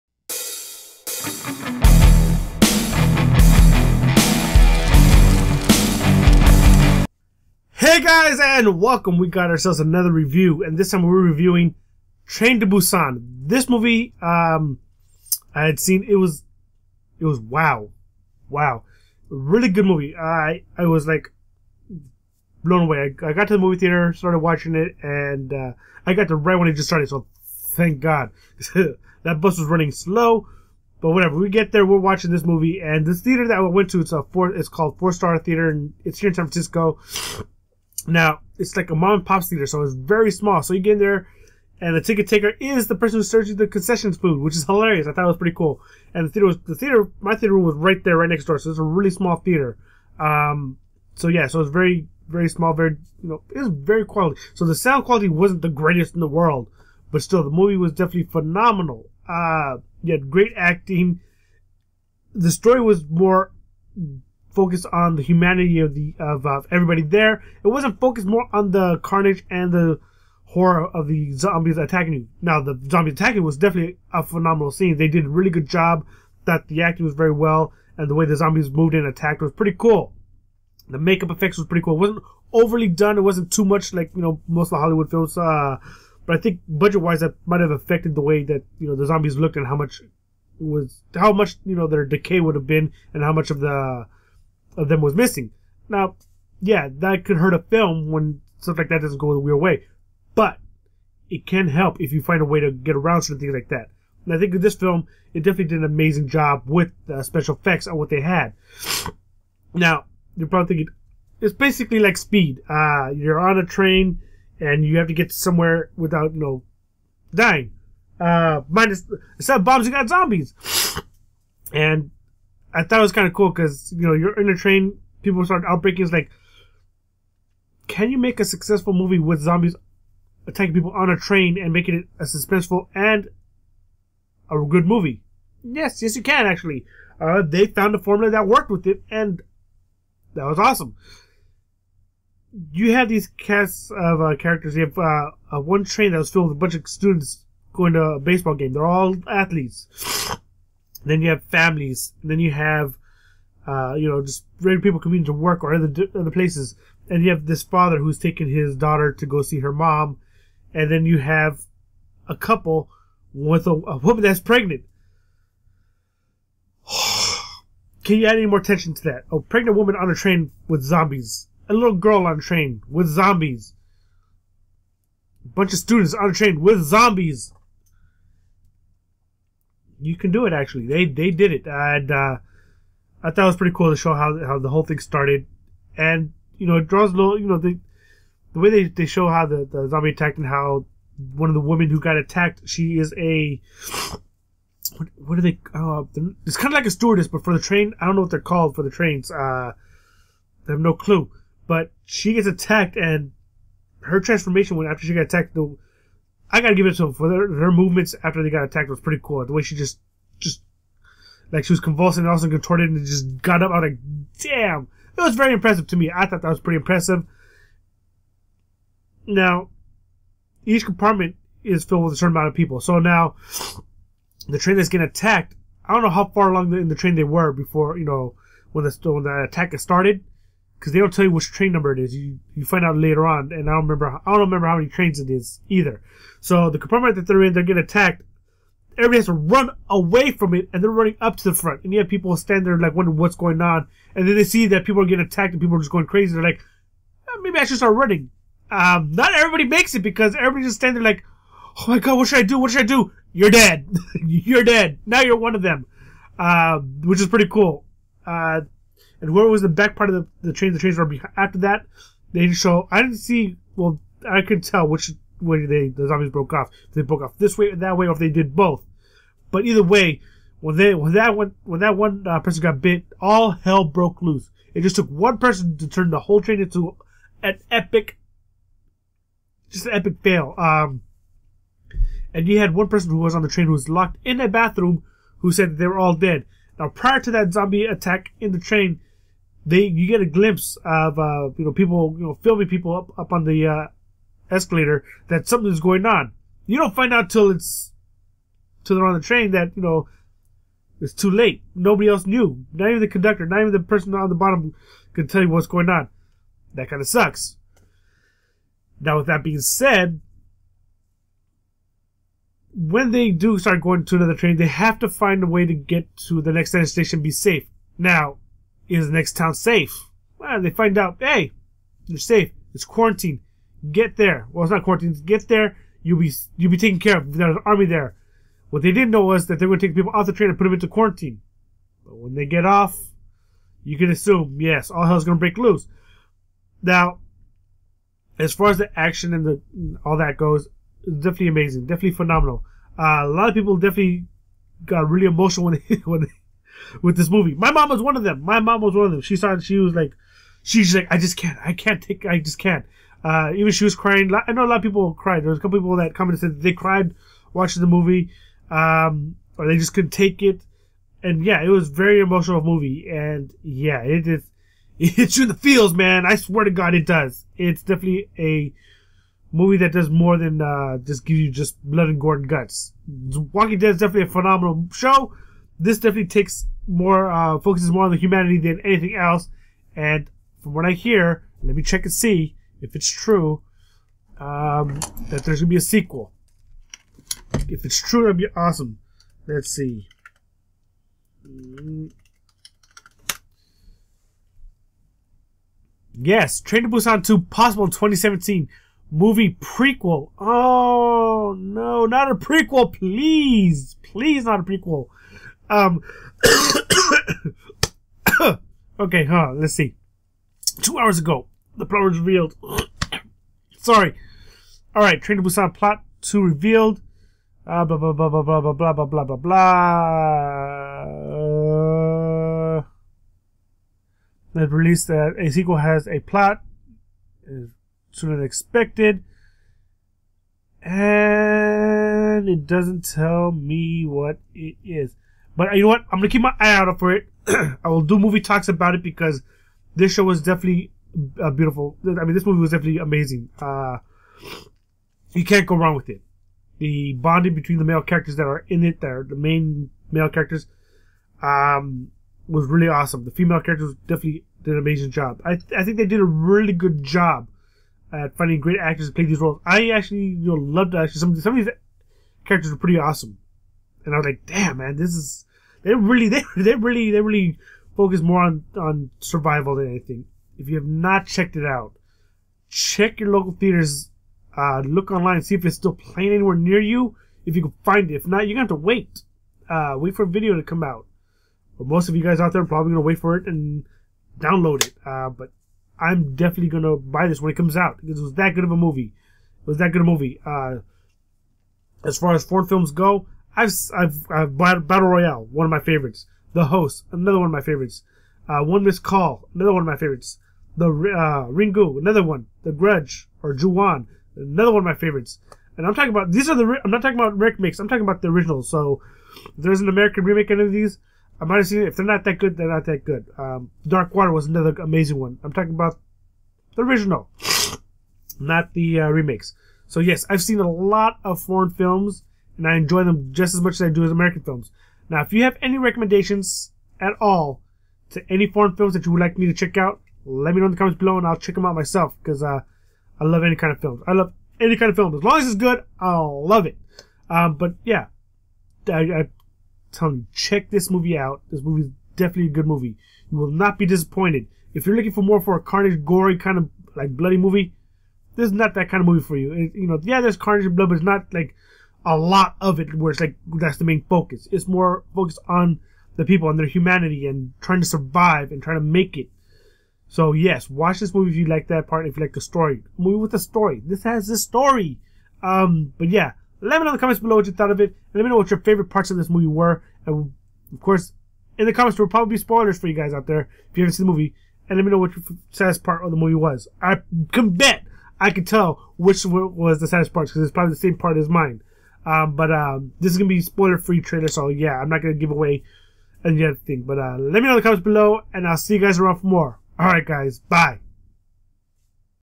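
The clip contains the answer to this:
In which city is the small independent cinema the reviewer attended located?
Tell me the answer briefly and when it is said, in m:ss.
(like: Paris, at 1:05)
San Francisco, at 0:36.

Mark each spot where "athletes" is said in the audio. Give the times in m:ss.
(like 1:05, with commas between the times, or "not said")
2:29.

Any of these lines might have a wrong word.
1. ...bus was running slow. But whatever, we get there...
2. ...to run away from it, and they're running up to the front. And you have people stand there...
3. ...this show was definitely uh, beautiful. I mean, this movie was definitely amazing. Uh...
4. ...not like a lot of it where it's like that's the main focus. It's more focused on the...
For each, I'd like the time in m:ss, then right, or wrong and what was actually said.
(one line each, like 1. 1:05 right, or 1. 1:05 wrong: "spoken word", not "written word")
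1. 0:29 right
2. 3:59 right
3. 7:19 right
4. 9:11 right.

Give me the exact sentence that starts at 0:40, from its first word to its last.
So you get in there, and the ticket taker is the person who serves you the concessions food, which is hilarious.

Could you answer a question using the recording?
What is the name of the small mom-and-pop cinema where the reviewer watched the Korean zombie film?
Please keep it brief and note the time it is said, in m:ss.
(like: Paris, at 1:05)
Four Star Theater, at 0:34.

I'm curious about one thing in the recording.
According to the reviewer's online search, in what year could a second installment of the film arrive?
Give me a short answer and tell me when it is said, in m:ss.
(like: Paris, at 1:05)
2017, at 6:37.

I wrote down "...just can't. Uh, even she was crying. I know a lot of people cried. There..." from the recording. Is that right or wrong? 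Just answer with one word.
right.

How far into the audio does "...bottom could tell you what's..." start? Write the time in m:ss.
5:04.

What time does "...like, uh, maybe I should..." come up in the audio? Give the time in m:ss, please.
4:06.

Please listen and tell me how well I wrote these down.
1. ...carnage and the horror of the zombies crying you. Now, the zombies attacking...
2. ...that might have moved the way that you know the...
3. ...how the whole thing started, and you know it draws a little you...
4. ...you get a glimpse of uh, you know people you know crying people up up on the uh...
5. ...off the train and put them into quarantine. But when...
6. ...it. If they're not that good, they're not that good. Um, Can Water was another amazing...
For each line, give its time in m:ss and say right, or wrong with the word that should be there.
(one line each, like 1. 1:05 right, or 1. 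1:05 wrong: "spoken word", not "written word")
1. 1:08 wrong: "attacking", not "crying"
2. 1:27 wrong: "affected", not "moved"
3. 3:04 right
4. 4:49 wrong: "filming", not "crying"
5. 5:30 right
6. 8:31 wrong: "Dark", not "Can".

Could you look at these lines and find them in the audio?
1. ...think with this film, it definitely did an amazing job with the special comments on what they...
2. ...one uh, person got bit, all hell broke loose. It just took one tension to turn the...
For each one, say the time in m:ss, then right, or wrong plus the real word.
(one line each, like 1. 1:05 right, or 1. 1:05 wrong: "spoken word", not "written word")
1. 1:44 wrong: "effects", not "comments"
2. 4:31 wrong: "person", not "tension".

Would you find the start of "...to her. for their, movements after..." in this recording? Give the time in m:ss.
3:26.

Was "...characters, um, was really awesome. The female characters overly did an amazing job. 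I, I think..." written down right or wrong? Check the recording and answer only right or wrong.
wrong.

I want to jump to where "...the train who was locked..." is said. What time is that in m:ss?
4:43.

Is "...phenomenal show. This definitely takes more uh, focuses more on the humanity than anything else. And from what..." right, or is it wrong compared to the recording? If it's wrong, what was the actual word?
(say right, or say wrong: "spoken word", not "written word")
right.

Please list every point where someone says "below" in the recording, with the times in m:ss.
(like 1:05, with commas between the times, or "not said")
8:50, 9:27, 9:47.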